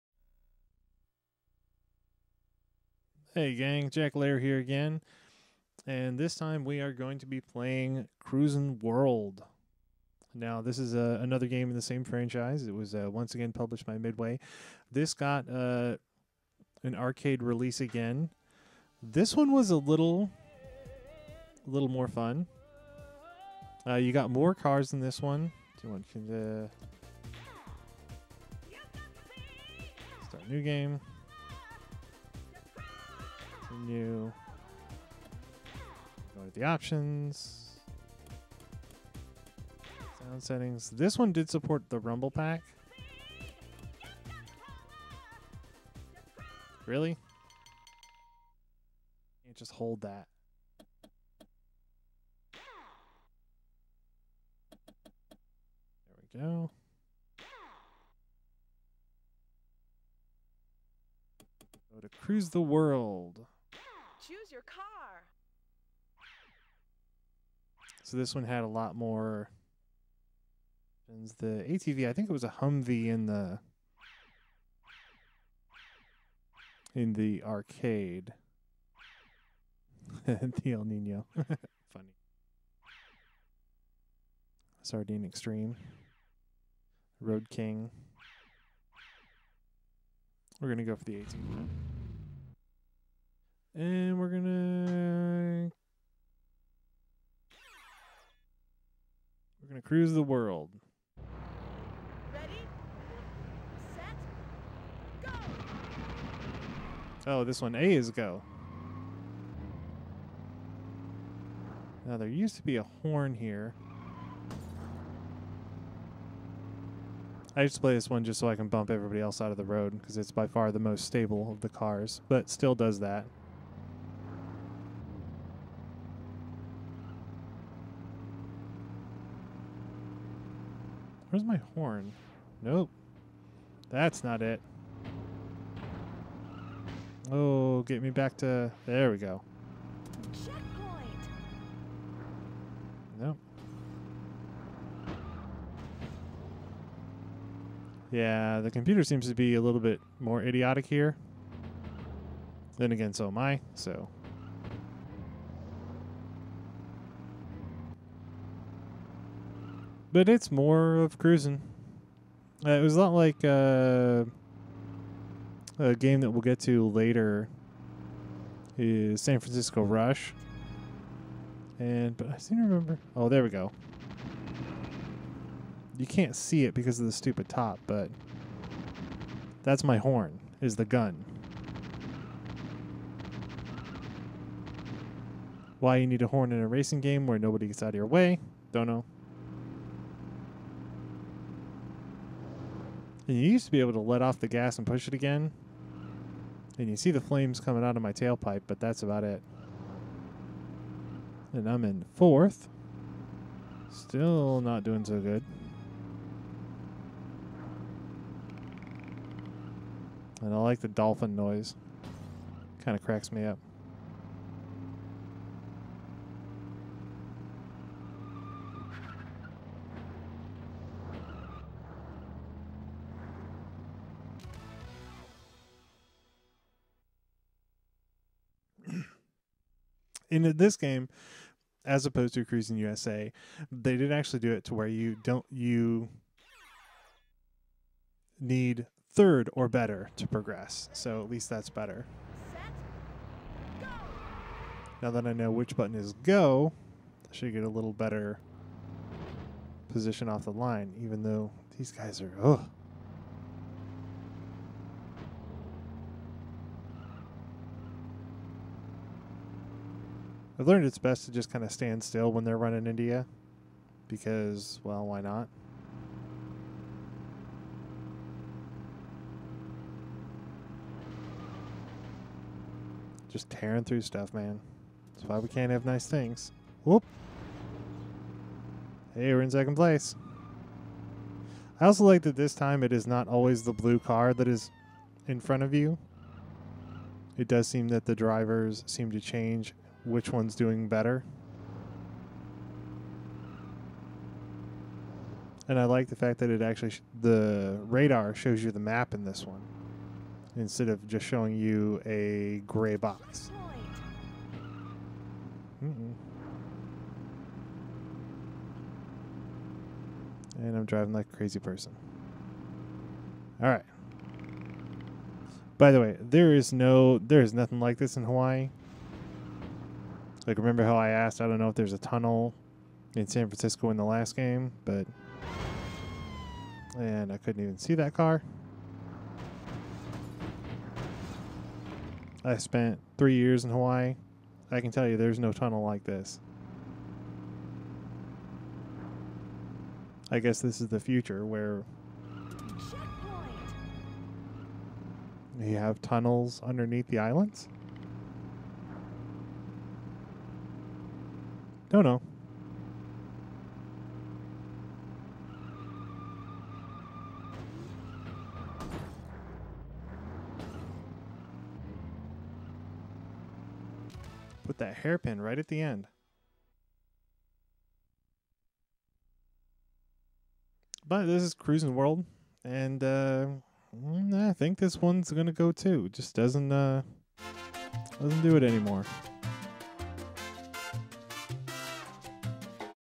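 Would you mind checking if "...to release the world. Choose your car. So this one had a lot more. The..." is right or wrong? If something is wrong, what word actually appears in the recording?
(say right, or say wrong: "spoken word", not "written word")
wrong: "cruise", not "release".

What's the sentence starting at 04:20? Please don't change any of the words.
I've learned it's best to just kind of stand still when they're running India, because, well, why not?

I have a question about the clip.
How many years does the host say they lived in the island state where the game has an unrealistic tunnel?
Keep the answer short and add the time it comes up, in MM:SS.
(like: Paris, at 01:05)
3, at 05:33.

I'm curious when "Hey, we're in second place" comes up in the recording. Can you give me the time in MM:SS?
04:39.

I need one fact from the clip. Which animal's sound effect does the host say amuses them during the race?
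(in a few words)
dolphin.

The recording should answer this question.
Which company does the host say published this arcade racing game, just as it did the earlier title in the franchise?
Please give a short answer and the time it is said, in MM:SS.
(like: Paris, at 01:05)
Midway, at 00:13.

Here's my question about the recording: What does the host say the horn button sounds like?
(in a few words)
gun.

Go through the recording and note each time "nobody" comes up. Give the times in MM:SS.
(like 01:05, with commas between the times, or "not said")
03:07.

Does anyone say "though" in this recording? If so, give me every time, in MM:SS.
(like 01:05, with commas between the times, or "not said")
04:11.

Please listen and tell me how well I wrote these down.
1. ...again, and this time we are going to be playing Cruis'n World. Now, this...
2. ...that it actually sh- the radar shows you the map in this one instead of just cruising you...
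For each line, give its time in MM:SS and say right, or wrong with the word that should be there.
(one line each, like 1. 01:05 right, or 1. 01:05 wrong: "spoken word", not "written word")
1. 00:04 right
2. 04:56 wrong: "showing", not "cruising".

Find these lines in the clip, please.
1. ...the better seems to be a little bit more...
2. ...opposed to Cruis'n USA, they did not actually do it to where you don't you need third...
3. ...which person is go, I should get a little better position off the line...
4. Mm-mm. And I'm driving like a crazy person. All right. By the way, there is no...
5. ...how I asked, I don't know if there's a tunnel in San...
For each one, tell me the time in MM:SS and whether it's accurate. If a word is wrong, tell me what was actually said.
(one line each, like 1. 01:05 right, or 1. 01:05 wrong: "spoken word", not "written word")
1. 02:28 wrong: "computer", not "better"
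2. 03:52 right
3. 04:05 wrong: "button", not "person"
4. 05:05 right
5. 05:20 right.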